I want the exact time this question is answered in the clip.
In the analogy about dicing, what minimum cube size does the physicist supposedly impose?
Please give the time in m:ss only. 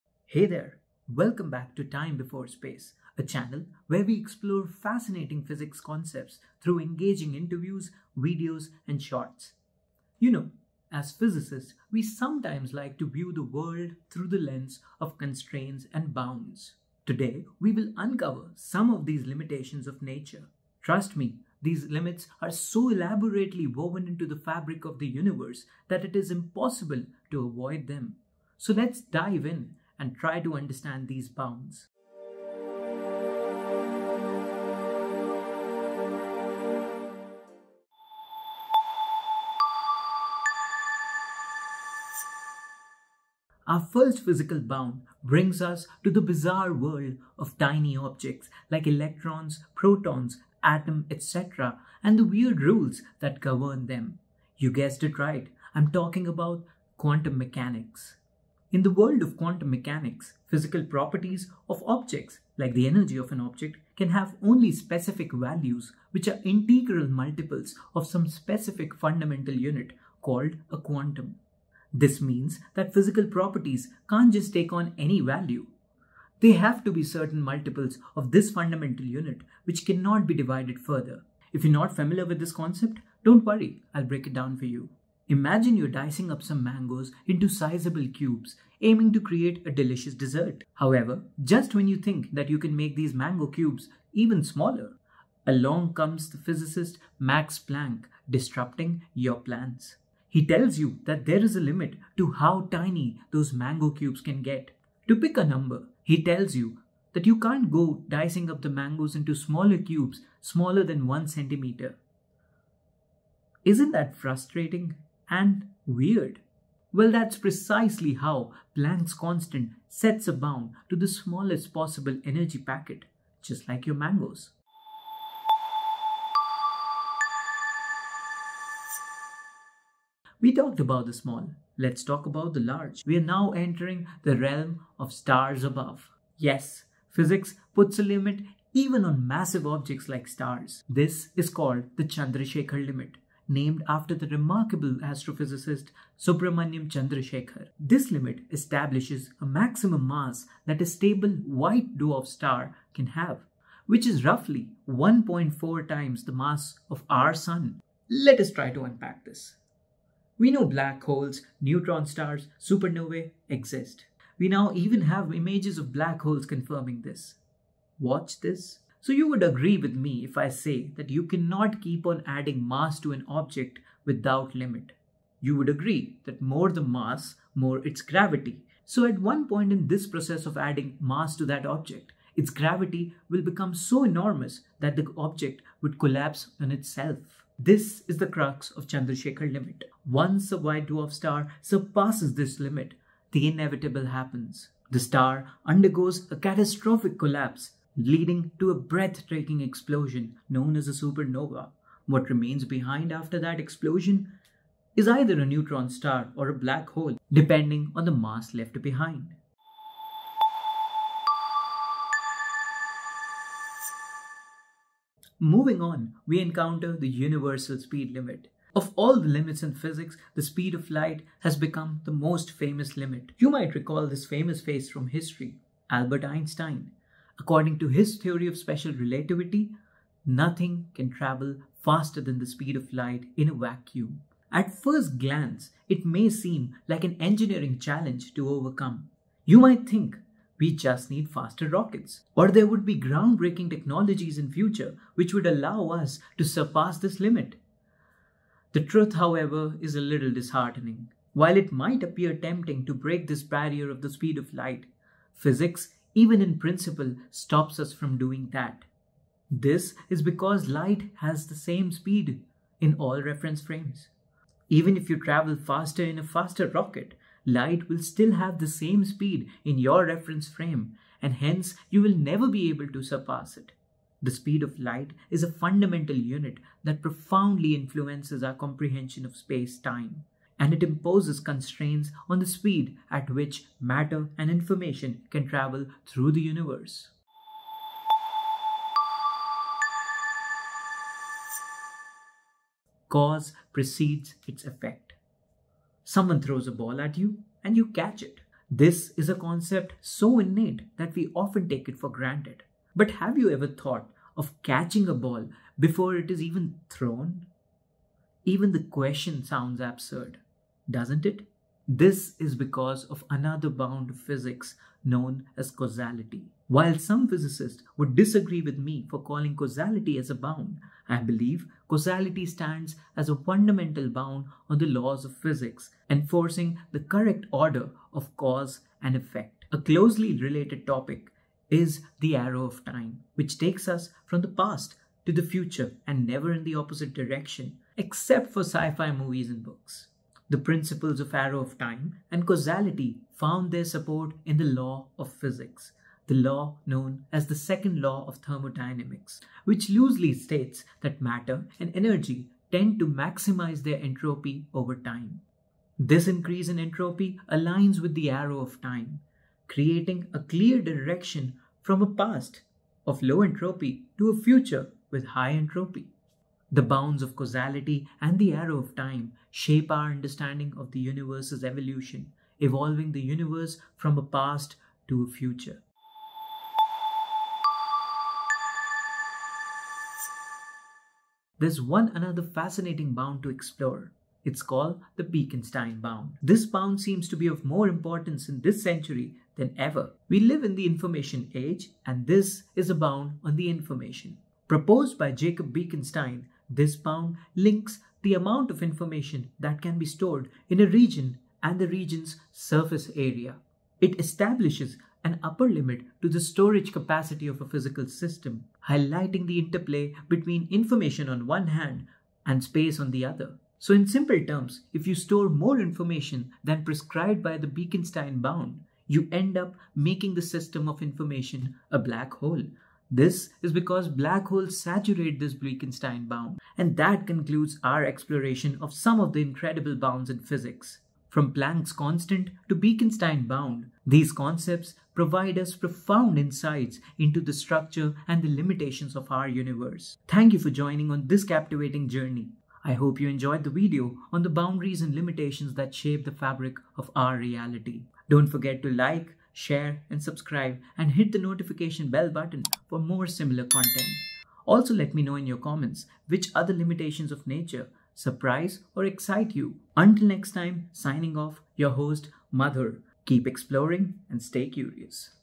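1:51.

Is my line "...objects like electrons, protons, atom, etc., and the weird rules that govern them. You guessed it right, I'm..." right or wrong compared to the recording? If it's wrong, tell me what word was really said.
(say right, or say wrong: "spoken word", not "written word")
right.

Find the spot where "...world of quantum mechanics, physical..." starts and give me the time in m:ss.
0:58.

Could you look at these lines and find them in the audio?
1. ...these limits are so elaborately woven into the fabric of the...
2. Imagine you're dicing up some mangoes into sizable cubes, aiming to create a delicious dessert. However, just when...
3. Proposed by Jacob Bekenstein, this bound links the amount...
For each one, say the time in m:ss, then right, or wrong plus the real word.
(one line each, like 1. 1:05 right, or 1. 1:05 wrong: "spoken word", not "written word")
1. 0:21 right
2. 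1:25 right
3. 6:34 right.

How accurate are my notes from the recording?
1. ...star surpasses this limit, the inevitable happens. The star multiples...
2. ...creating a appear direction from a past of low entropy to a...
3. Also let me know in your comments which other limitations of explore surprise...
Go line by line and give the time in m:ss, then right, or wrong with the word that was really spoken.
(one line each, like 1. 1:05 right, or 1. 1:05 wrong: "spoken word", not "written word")
1. 3:11 wrong: "undergoes", not "multiples"
2. 5:59 wrong: "clear", not "appear"
3. 7:34 wrong: "nature", not "explore".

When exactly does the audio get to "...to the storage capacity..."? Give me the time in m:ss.
6:46.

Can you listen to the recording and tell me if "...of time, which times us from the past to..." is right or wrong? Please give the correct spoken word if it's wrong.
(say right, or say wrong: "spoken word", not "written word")
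wrong: "takes", not "times".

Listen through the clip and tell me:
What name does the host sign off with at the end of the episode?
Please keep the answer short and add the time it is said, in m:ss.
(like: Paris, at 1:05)
Mother, at 7:42.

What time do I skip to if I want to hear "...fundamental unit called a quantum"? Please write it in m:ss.
1:08.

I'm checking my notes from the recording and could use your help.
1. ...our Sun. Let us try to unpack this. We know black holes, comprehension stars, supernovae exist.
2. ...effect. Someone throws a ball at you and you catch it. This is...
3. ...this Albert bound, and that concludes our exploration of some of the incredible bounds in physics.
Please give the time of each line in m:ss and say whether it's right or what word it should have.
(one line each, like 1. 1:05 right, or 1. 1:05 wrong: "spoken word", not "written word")
1. 2:37 wrong: "neutron", not "comprehension"
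2. 4:54 right
3. 7:05 wrong: "Bekenstein", not "Albert".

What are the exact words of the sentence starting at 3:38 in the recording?
Of all the limits in physics, the speed of light has become the most famous limit.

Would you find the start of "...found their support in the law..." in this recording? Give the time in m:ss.
5:43.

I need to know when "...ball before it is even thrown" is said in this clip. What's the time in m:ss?
5:05.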